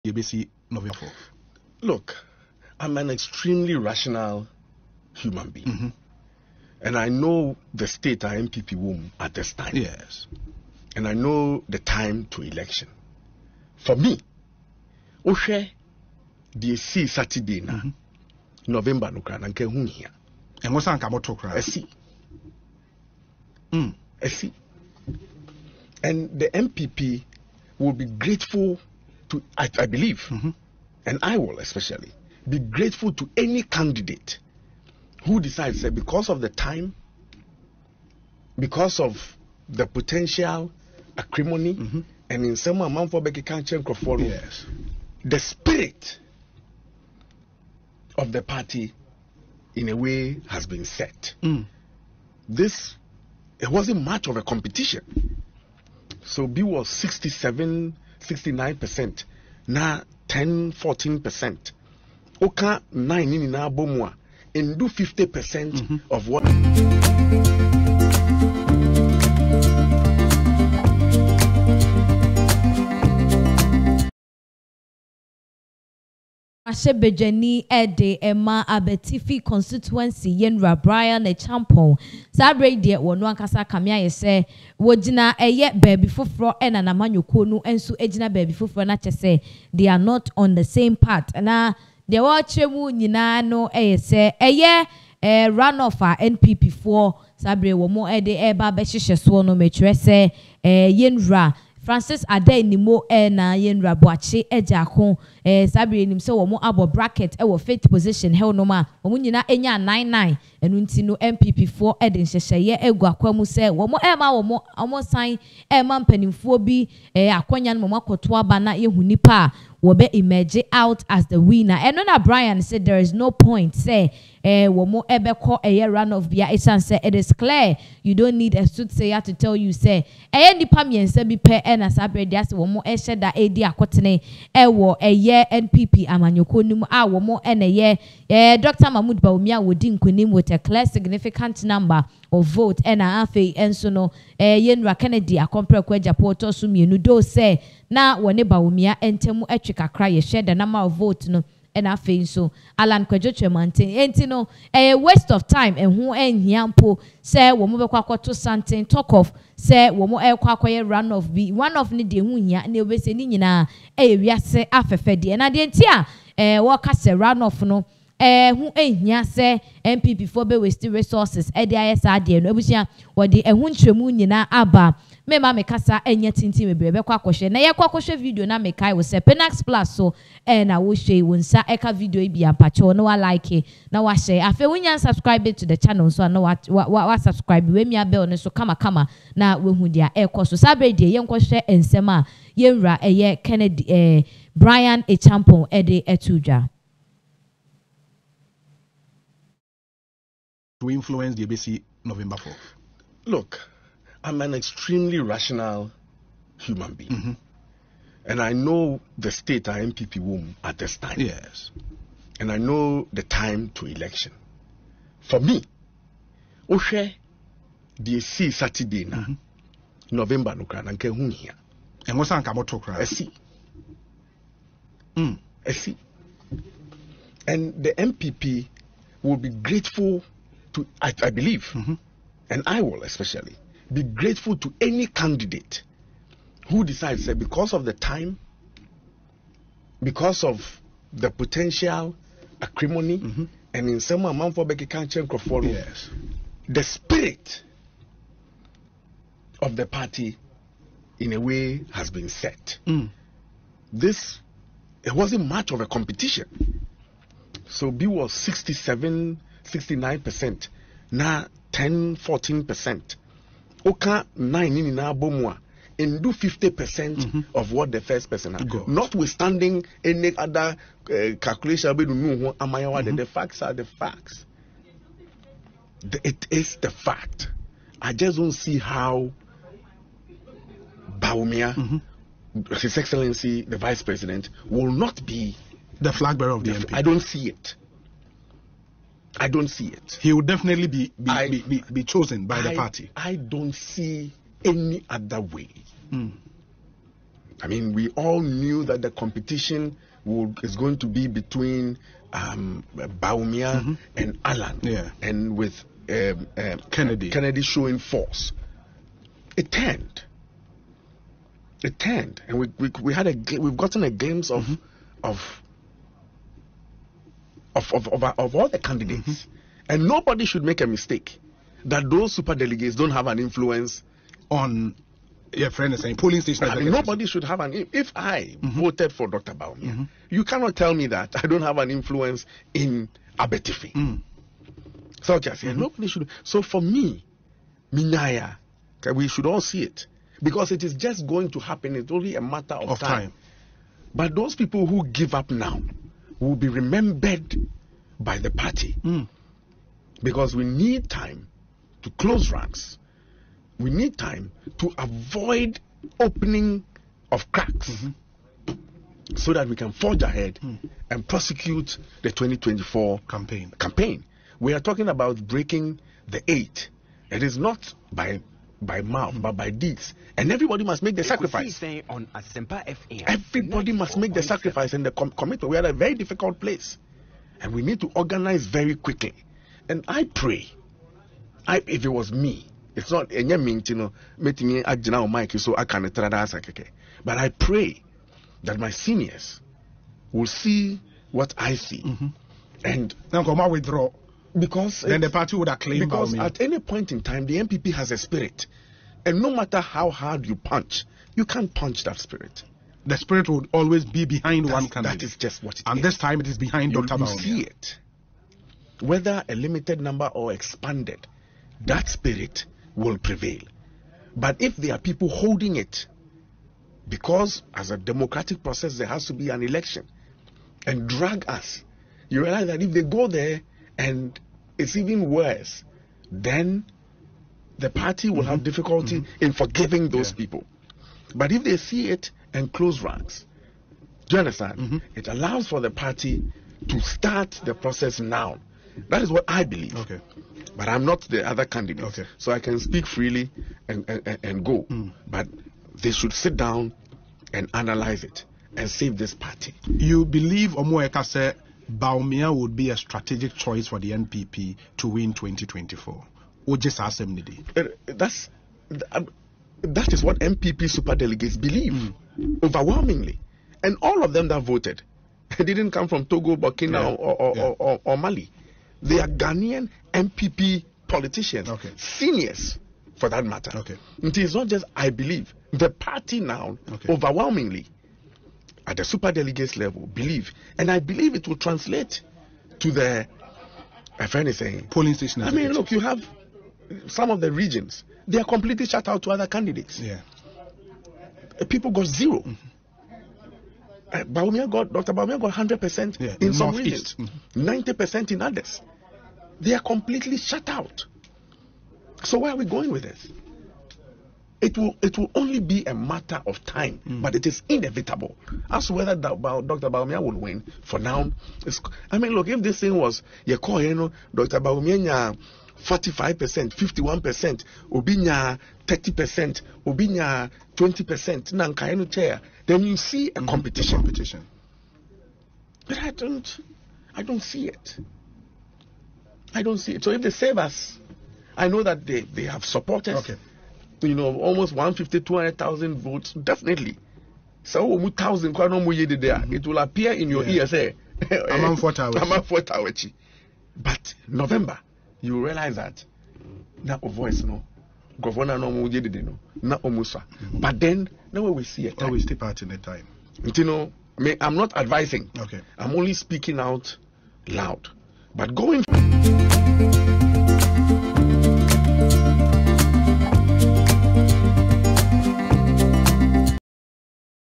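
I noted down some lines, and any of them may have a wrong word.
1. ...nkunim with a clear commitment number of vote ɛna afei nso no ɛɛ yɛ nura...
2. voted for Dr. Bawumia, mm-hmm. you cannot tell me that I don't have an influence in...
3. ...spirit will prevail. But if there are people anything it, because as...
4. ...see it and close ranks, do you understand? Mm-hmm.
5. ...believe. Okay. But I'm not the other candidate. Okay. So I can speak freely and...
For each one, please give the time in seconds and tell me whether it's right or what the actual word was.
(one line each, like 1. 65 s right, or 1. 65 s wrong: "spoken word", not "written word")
1. 139 s wrong: "significant", not "commitment"
2. 328 s right
3. 412 s wrong: "holding", not "anything"
4. 431 s right
5. 439 s right.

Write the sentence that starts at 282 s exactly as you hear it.
His Excellency, the Vice President, will not be the flag bearer of the, the MP.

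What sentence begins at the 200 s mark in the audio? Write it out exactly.
to influence the ABC November 4 Look, I'm an extremely rational human being.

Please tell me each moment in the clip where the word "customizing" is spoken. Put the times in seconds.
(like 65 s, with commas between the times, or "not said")
not said.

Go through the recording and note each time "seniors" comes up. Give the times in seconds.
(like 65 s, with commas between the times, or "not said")
388 s, 471 s.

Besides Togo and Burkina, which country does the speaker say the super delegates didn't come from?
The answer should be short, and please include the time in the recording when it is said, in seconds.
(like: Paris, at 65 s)
Mali, at 468 s.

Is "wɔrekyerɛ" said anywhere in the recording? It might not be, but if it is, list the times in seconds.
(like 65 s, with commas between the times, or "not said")
92 s.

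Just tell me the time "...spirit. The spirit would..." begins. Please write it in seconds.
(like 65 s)
402 s.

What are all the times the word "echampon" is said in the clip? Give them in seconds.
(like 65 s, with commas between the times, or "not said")
81 s, 195 s.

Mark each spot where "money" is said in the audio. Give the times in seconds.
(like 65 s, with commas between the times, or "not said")
not said.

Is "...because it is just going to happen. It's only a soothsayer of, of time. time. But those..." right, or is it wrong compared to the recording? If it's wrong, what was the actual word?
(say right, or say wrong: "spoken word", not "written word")
wrong: "matter", not "soothsayer".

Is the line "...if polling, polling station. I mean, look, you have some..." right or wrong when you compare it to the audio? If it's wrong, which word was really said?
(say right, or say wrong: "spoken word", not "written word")
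wrong: "anything", not "polling".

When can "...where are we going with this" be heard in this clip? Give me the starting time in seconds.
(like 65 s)
502 s.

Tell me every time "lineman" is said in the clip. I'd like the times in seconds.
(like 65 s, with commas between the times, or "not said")
not said.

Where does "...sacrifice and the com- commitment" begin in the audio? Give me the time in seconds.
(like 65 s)
374 s.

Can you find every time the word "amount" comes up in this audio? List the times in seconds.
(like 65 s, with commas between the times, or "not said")
42 s, 244 s.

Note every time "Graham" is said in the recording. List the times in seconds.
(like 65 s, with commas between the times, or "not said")
not said.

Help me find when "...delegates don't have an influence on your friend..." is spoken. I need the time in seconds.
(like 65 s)
322 s.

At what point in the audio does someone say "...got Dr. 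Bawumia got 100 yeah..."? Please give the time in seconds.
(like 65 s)
494 s.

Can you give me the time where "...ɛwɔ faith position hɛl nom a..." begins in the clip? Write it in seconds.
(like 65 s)
107 s.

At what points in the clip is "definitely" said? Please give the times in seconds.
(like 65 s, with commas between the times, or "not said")
290 s, 536 s.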